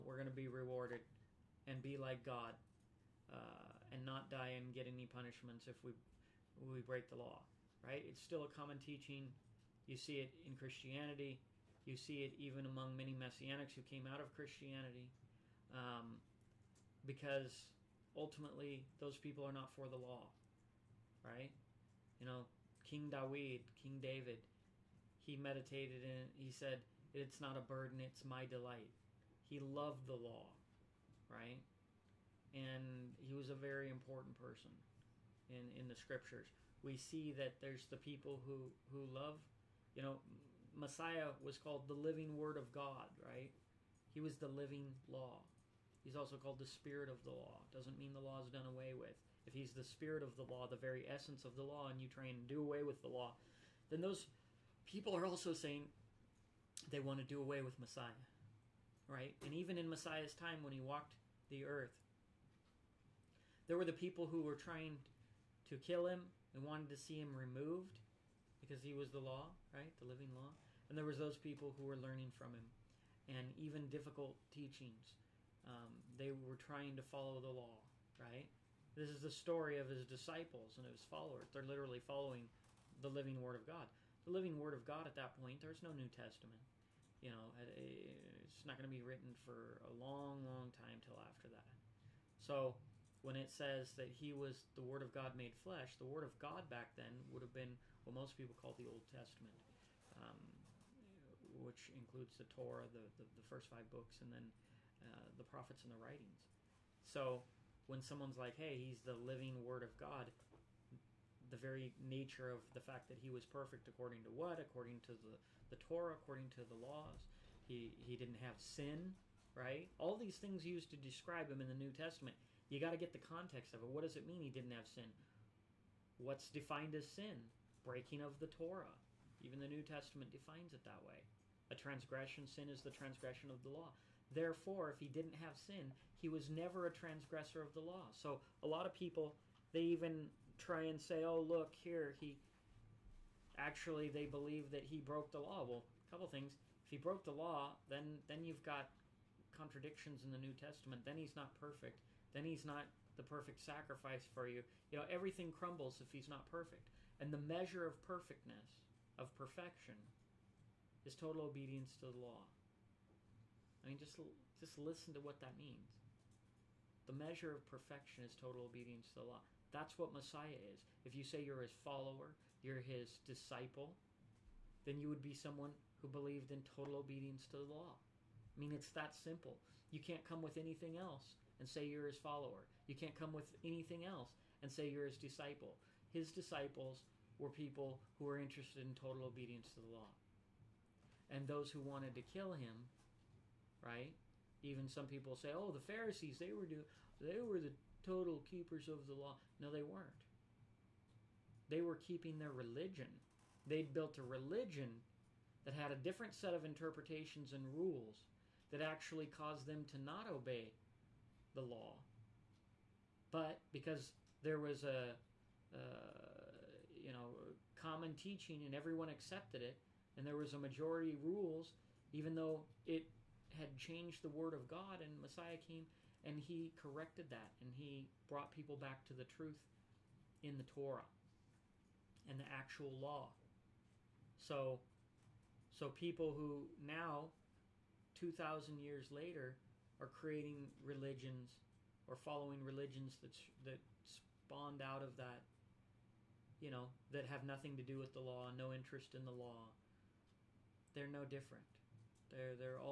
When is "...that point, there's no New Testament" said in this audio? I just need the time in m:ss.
1:25.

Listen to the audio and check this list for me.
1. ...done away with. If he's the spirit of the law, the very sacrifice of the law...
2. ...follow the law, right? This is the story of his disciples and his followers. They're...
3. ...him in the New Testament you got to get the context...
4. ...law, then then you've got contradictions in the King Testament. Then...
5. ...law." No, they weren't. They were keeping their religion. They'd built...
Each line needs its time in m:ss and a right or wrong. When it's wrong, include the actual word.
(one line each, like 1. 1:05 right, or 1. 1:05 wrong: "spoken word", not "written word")
1. 0:48 wrong: "essence", not "sacrifice"
2. 1:17 right
3. 2:01 right
4. 2:27 wrong: "New", not "King"
5. 3:19 right.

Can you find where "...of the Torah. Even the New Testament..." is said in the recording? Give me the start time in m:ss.
2:08.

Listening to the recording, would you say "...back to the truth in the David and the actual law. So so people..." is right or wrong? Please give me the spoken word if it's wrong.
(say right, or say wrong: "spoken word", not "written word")
wrong: "Torah", not "David".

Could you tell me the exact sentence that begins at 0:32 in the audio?
and he was a very important person in in the scriptures.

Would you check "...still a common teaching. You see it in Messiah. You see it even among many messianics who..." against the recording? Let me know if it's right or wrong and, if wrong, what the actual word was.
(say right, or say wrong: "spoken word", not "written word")
wrong: "Christianity", not "Messiah".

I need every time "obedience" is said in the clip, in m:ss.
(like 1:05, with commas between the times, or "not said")
2:41, 2:48, 2:56, 3:09.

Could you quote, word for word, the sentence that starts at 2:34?
You know, everything crumbles if he's not perfect.